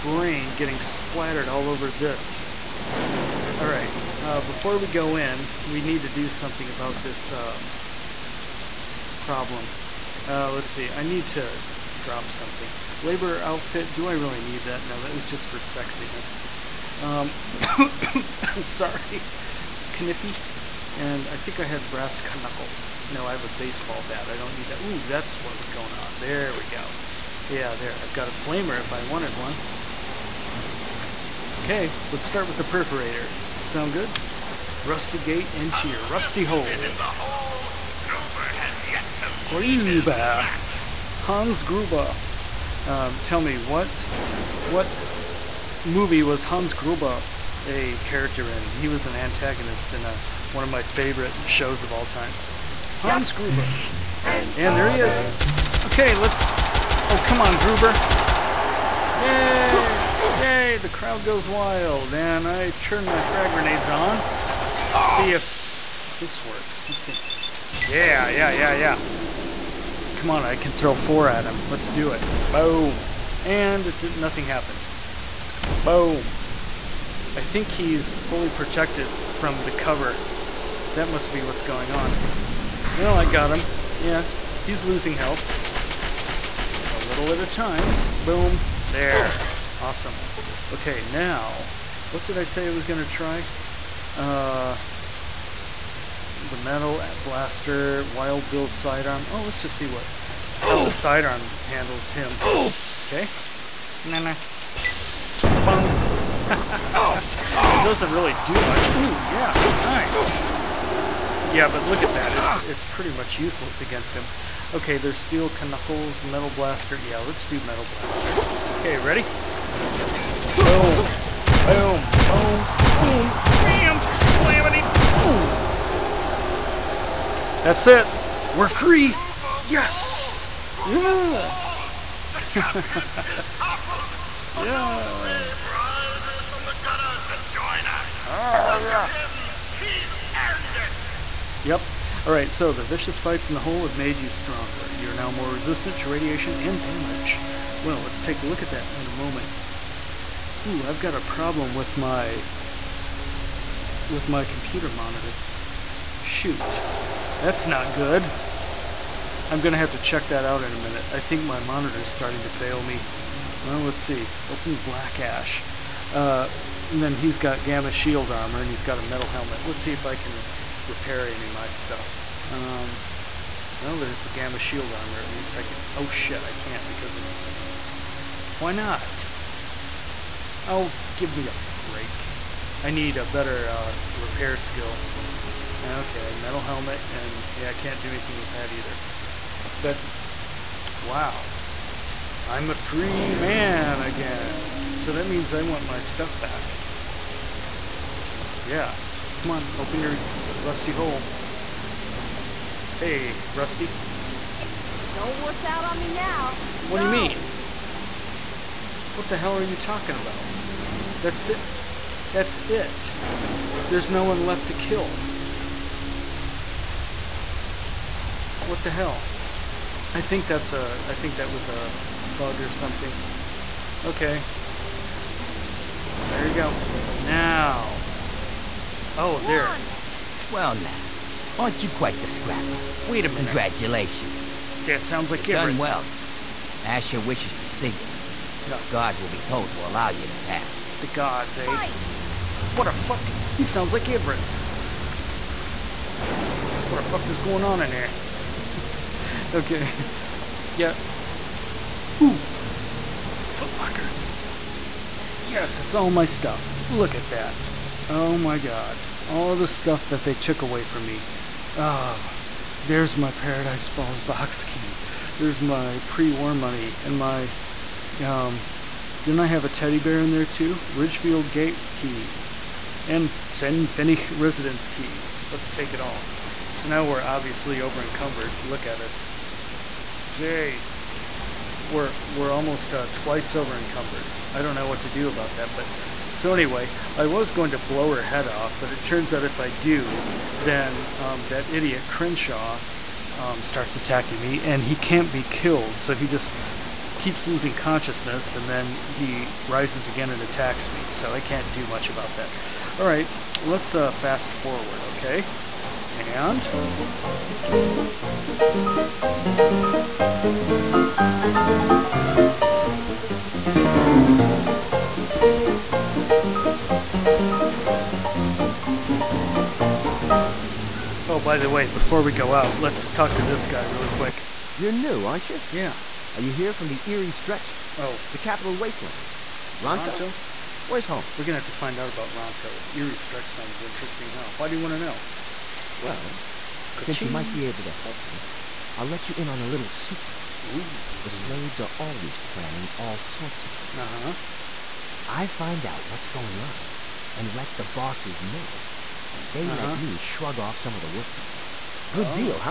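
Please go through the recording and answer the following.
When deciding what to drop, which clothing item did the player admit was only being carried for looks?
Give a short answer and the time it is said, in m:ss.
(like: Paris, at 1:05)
Labor outfit, at 0:13.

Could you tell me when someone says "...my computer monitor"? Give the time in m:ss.
2:34.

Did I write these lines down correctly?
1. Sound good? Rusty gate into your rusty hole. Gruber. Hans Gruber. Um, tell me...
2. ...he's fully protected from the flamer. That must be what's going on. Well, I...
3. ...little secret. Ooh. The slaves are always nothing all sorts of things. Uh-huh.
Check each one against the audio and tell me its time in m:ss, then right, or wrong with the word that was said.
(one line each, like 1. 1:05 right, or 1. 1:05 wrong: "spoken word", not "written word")
1. 0:33 right
2. 1:17 wrong: "cover", not "flamer"
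3. 5:39 wrong: "planning", not "nothing".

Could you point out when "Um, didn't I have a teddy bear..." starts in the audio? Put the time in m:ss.
4:28.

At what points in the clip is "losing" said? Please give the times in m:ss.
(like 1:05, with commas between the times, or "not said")
1:24, 4:57.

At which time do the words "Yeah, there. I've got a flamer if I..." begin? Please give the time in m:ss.
0:27.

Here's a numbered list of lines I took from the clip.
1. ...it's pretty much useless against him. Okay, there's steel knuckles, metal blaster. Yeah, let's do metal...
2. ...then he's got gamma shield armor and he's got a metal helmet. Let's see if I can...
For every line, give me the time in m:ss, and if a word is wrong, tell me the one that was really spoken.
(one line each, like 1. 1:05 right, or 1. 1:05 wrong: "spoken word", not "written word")
1. 1:52 right
2. 2:47 right.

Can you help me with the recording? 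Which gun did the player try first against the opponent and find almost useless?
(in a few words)
Wild Bill's sidearm.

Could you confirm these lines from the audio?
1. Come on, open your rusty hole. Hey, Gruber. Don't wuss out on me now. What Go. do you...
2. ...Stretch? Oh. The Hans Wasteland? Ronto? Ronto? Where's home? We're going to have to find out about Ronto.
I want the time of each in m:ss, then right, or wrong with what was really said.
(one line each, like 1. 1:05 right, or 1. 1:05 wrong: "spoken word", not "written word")
1. 3:19 wrong: "Rusty", not "Gruber"
2. 5:27 wrong: "Capital", not "Hans".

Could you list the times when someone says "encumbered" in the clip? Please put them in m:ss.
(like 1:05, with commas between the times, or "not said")
4:38, 4:43.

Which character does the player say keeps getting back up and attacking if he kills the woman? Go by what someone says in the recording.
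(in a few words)
Crenshaw.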